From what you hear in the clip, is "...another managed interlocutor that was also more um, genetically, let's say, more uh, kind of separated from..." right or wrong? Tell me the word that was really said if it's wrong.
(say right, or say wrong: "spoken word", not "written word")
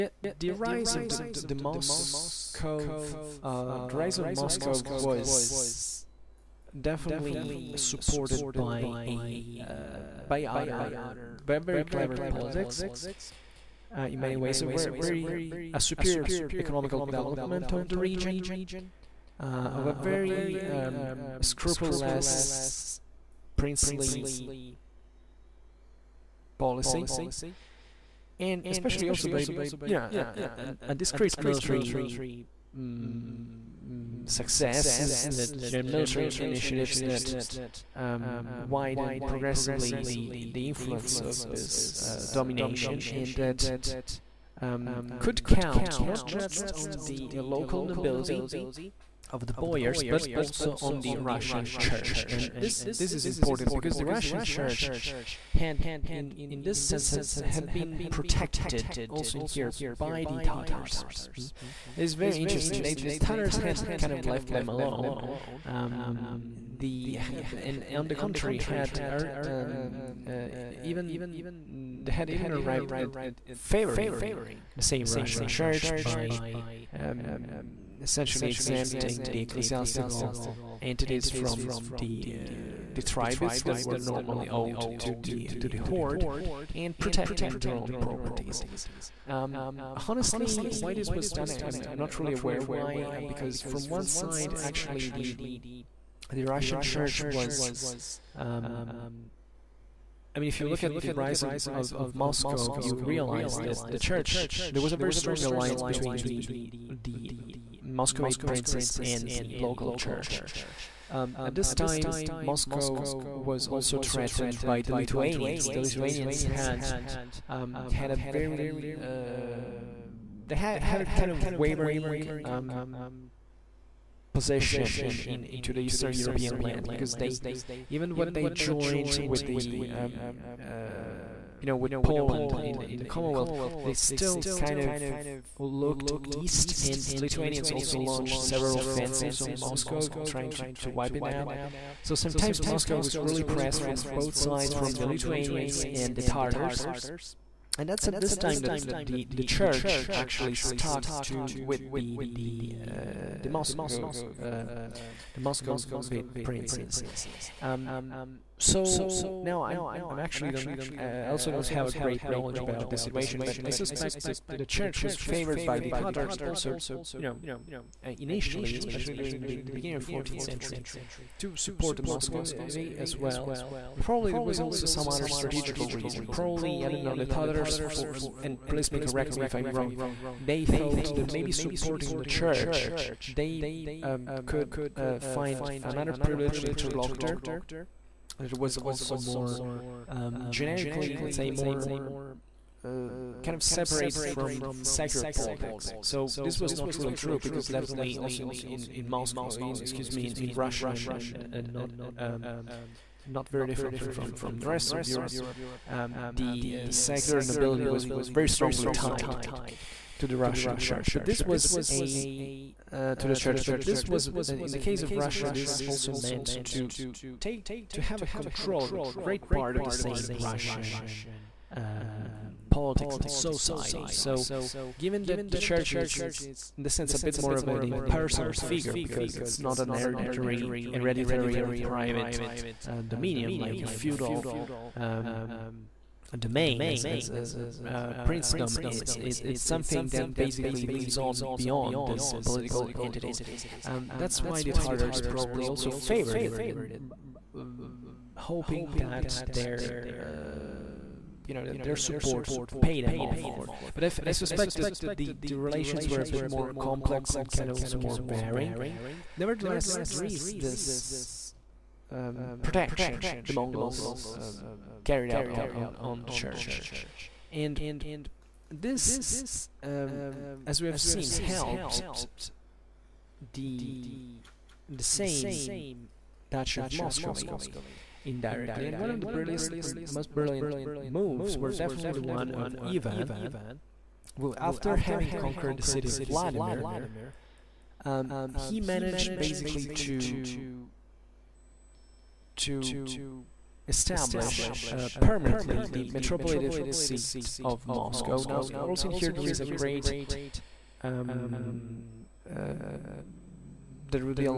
wrong: "privileged", not "managed".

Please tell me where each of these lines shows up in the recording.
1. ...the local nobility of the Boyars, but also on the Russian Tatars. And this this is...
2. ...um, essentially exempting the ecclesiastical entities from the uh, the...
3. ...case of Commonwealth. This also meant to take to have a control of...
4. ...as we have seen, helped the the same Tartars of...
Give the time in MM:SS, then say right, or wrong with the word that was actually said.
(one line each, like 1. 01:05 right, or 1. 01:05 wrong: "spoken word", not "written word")
1. 00:47 wrong: "Church", not "Tatars"
2. 01:16 right
3. 03:34 wrong: "Russia", not "Commonwealth"
4. 04:30 wrong: "Duchy", not "Tartars".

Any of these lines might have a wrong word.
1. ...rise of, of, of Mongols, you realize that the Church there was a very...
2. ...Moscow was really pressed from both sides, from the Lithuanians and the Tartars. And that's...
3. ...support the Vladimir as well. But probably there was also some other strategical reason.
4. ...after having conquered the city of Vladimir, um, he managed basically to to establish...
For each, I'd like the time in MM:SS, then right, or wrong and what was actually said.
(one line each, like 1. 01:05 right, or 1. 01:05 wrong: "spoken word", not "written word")
1. 01:41 wrong: "Moscow", not "Mongols"
2. 02:22 right
3. 02:51 wrong: "Muscovy", not "Vladimir"
4. 04:44 right.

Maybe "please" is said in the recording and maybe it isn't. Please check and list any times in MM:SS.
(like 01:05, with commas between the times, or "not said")
02:58.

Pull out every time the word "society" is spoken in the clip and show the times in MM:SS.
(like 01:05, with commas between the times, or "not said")
03:43.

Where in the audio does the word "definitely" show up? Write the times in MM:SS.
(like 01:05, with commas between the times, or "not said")
00:06, 03:17, 04:41.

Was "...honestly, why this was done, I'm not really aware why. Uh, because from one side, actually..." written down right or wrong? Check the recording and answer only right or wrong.
right.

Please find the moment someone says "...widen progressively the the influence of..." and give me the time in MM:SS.
00:38.